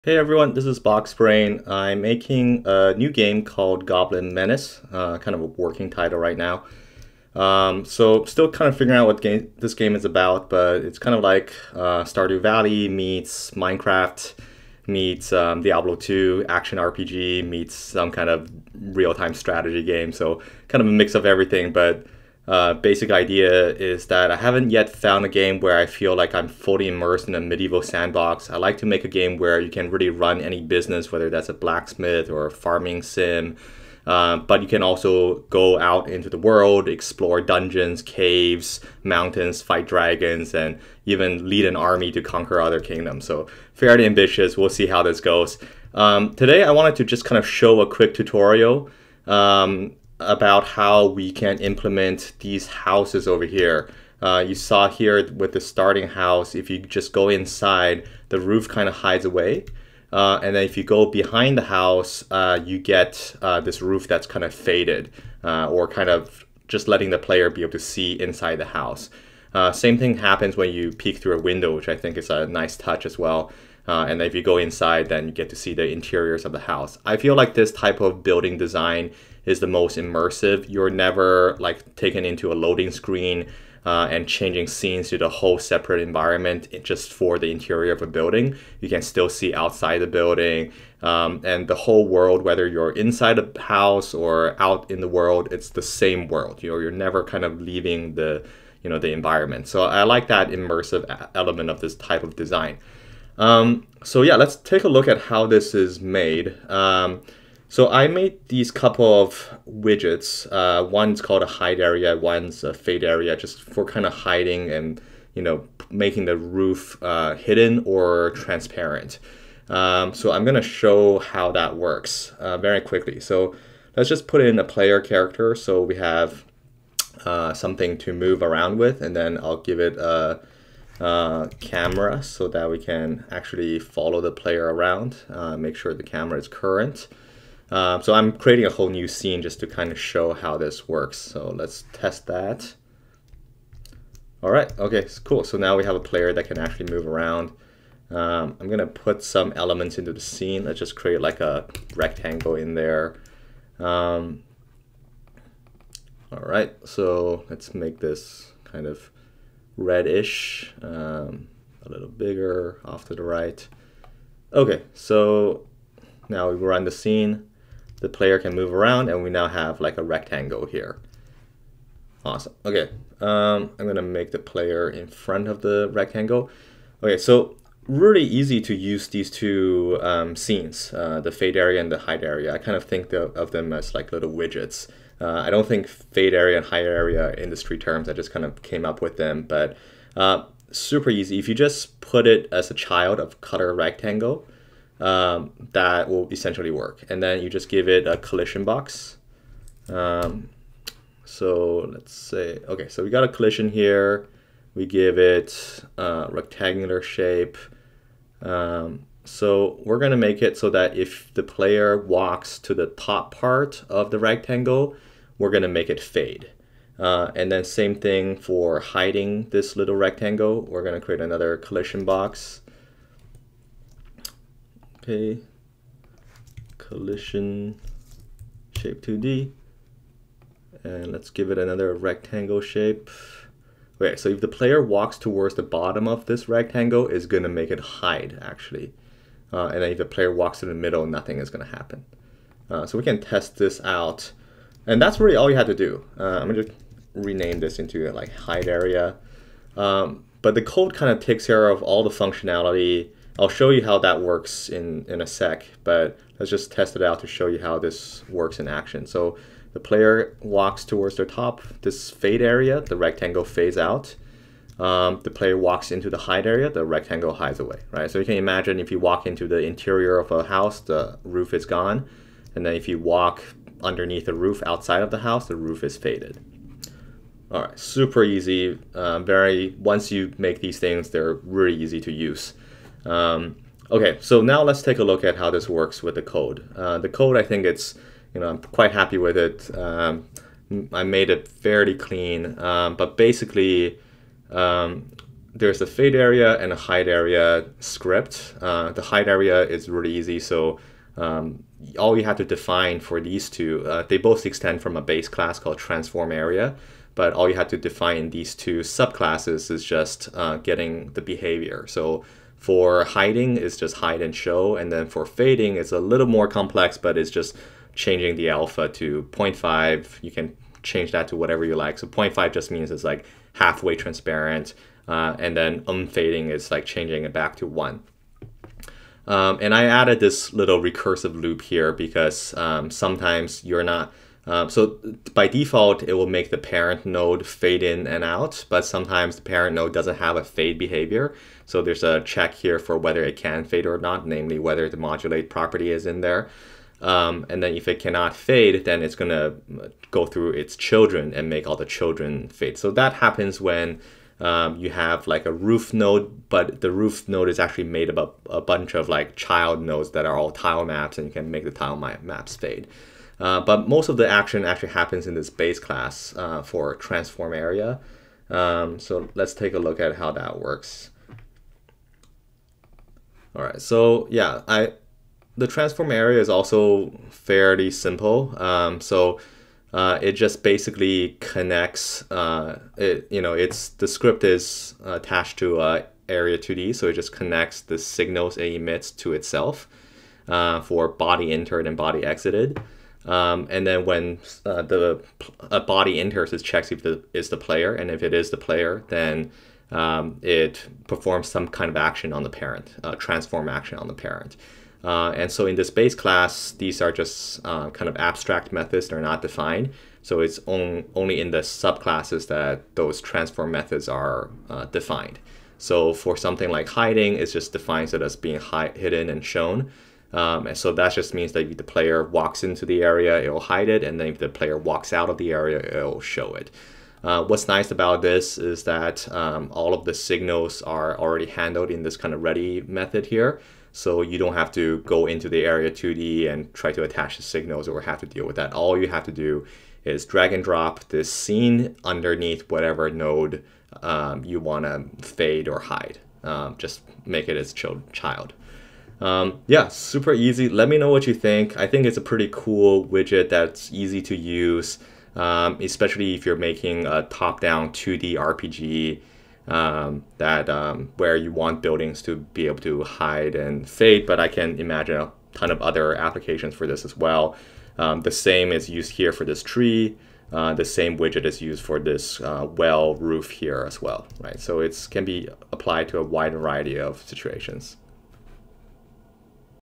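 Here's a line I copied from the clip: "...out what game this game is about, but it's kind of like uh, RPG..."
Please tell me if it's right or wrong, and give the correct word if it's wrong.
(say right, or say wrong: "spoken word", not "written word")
wrong: "Stardew", not "RPG".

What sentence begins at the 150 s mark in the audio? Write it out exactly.
Let's just create like a rectangle in there.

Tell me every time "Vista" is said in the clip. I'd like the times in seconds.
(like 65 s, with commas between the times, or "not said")
not said.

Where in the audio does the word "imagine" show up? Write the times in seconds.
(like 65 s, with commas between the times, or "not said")
268 s, 464 s.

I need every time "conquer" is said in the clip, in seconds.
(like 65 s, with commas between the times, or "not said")
42 s.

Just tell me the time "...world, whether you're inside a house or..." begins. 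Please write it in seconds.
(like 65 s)
92 s.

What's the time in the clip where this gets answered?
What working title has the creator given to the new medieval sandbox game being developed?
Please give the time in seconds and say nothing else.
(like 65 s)
3 s.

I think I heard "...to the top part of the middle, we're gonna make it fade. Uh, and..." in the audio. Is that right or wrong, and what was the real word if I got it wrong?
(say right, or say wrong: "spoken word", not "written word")
wrong: "rectangle", not "middle".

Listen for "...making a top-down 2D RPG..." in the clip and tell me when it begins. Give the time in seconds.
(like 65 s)
456 s.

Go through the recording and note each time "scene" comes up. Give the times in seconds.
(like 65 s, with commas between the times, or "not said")
84 s, 139 s, 150 s, 166 s, 180 s, 441 s.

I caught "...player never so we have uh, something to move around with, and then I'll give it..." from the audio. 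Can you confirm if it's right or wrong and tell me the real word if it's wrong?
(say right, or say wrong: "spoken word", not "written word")
wrong: "character", not "never".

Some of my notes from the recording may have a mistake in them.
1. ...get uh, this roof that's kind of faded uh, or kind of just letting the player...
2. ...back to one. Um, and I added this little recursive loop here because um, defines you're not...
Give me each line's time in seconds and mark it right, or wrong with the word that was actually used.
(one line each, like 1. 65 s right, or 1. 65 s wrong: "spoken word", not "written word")
1. 62 s right
2. 327 s wrong: "sometimes", not "defines".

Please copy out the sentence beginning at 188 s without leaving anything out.
I just kind of came up with them, but uh, super easy.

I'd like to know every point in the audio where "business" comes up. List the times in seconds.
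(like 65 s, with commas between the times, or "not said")
30 s.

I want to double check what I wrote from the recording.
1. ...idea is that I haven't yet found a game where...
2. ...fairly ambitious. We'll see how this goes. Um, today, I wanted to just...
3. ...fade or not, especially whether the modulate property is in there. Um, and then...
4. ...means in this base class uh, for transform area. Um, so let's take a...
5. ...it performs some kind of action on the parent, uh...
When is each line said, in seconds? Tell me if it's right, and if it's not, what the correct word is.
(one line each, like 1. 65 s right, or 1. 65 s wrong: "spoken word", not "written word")
1. 23 s right
2. 43 s right
3. 343 s wrong: "namely", not "especially"
4. 364 s wrong: "happens", not "means"
5. 400 s right.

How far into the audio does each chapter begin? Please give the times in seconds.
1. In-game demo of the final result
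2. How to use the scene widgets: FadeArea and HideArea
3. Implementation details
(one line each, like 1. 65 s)
1. 45 s
2. 105 s
3. 282 s.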